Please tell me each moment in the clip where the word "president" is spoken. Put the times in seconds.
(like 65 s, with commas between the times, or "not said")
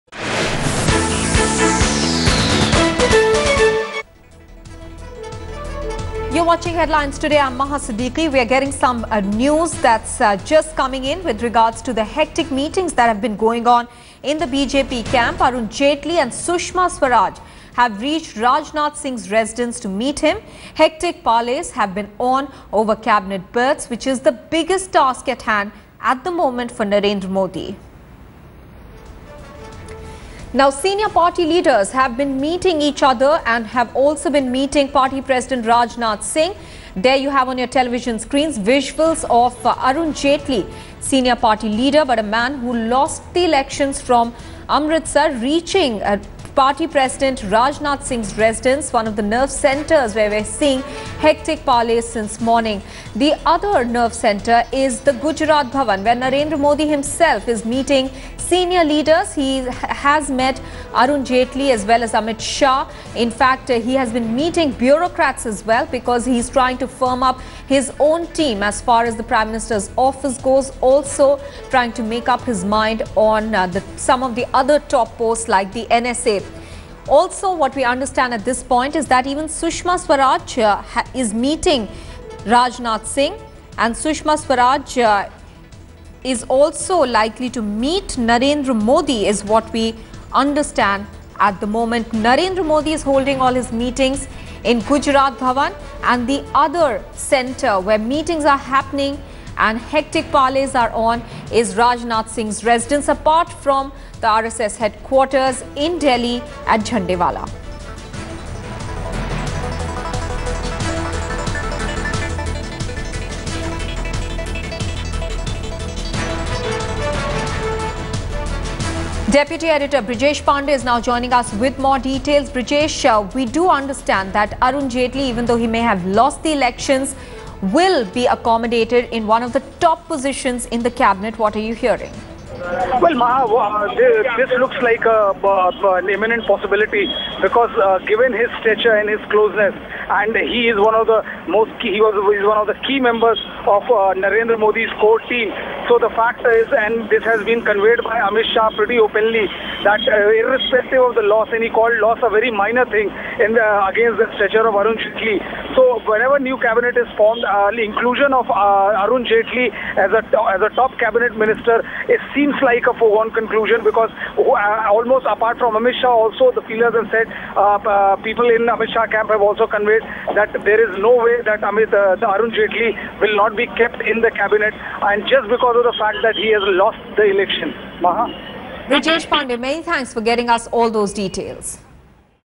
35 s, 46 s.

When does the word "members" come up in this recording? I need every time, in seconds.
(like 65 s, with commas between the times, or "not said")
142 s.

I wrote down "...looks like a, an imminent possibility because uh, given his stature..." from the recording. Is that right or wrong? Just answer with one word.
right.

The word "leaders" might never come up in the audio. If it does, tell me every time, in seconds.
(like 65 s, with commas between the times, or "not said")
31 s, 41 s, 58 s.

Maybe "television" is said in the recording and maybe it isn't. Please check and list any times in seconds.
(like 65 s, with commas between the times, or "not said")
37 s.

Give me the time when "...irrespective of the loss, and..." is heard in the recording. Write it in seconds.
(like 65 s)
150 s.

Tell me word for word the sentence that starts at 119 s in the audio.
Deputy Editor Brijesh Pandey is now joining us with more details.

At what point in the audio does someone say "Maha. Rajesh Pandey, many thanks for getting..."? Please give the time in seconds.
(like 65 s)
178 s.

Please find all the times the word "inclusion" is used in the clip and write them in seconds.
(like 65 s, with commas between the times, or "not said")
157 s.